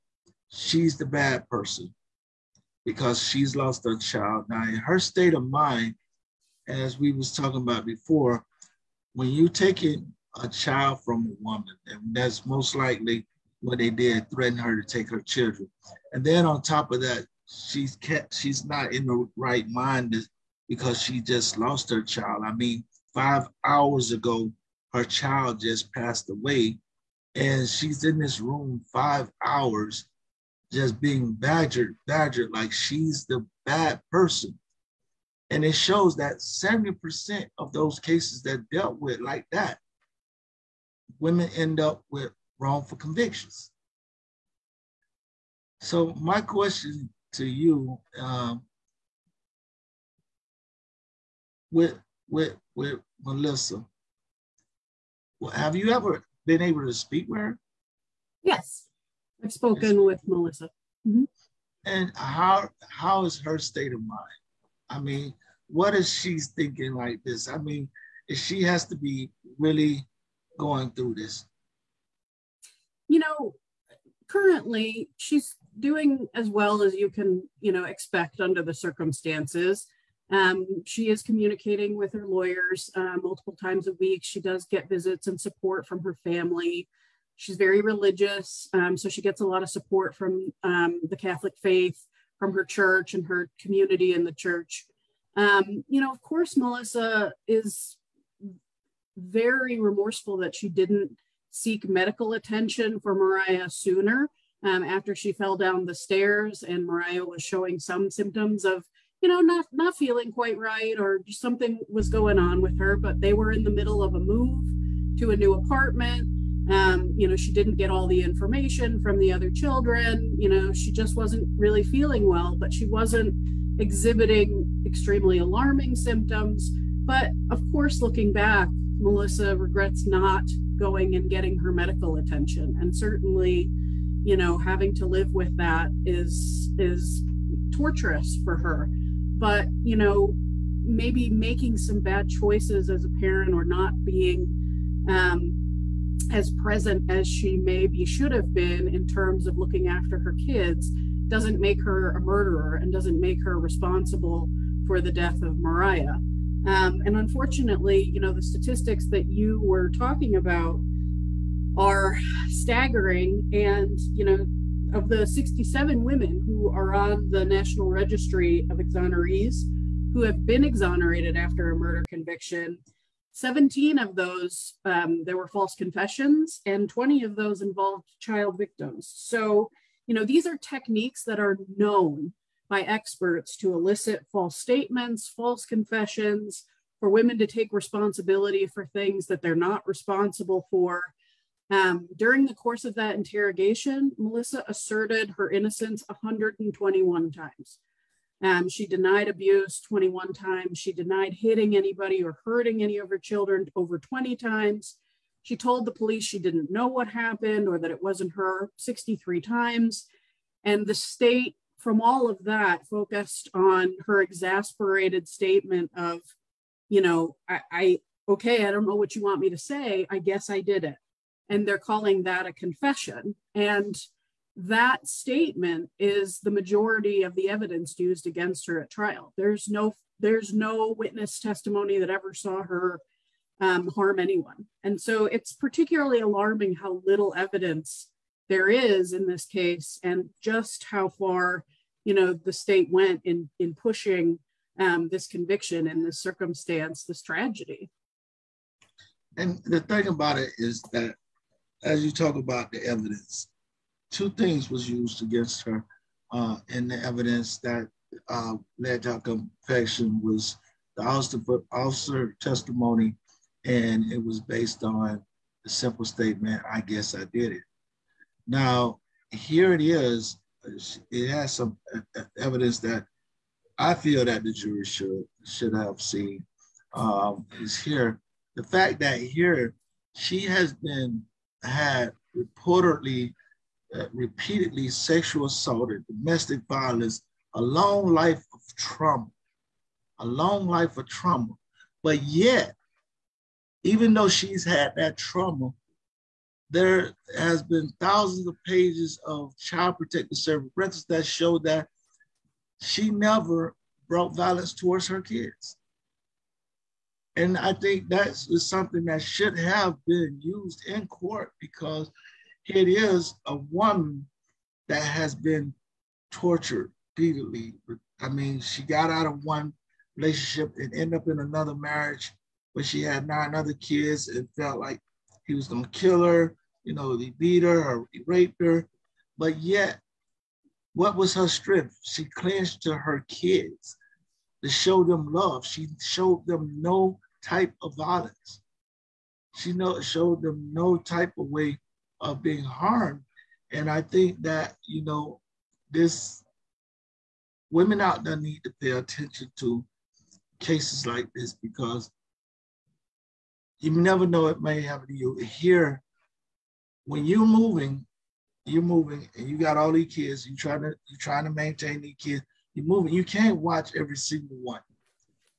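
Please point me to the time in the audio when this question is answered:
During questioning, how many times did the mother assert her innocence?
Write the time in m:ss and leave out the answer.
3:16.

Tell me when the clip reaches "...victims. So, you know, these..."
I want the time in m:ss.
2:58.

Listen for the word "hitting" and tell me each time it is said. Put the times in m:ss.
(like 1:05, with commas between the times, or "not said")
3:21.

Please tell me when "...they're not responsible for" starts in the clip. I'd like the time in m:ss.
3:09.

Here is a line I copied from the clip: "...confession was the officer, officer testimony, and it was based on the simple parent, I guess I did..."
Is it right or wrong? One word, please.
wrong.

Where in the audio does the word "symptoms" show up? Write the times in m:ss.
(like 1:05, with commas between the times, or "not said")
1:48, 2:05.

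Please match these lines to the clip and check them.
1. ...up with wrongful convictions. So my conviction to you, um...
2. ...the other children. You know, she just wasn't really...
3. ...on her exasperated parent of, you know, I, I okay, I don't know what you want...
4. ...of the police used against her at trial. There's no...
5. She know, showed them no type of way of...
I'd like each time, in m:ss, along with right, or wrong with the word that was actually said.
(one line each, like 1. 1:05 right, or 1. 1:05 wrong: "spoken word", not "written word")
1. 0:41 wrong: "question", not "conviction"
2. 1:59 right
3. 3:33 wrong: "statement", not "parent"
4. 3:47 wrong: "evidence", not "police"
5. 5:39 right.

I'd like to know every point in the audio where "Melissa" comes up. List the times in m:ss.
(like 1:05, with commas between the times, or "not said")
0:53, 1:00, 1:36, 2:08, 3:14.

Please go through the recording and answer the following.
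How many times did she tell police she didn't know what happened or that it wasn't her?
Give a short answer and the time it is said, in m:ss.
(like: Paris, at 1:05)
63, at 3:28.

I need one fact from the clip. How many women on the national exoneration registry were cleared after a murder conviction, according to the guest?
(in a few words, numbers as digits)
67.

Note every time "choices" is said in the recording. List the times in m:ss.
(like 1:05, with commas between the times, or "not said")
2:22.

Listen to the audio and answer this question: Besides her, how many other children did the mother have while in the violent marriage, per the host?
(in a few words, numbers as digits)
9.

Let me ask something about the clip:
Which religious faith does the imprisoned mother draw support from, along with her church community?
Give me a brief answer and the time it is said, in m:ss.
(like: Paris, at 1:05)
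Catholic, at 1:31.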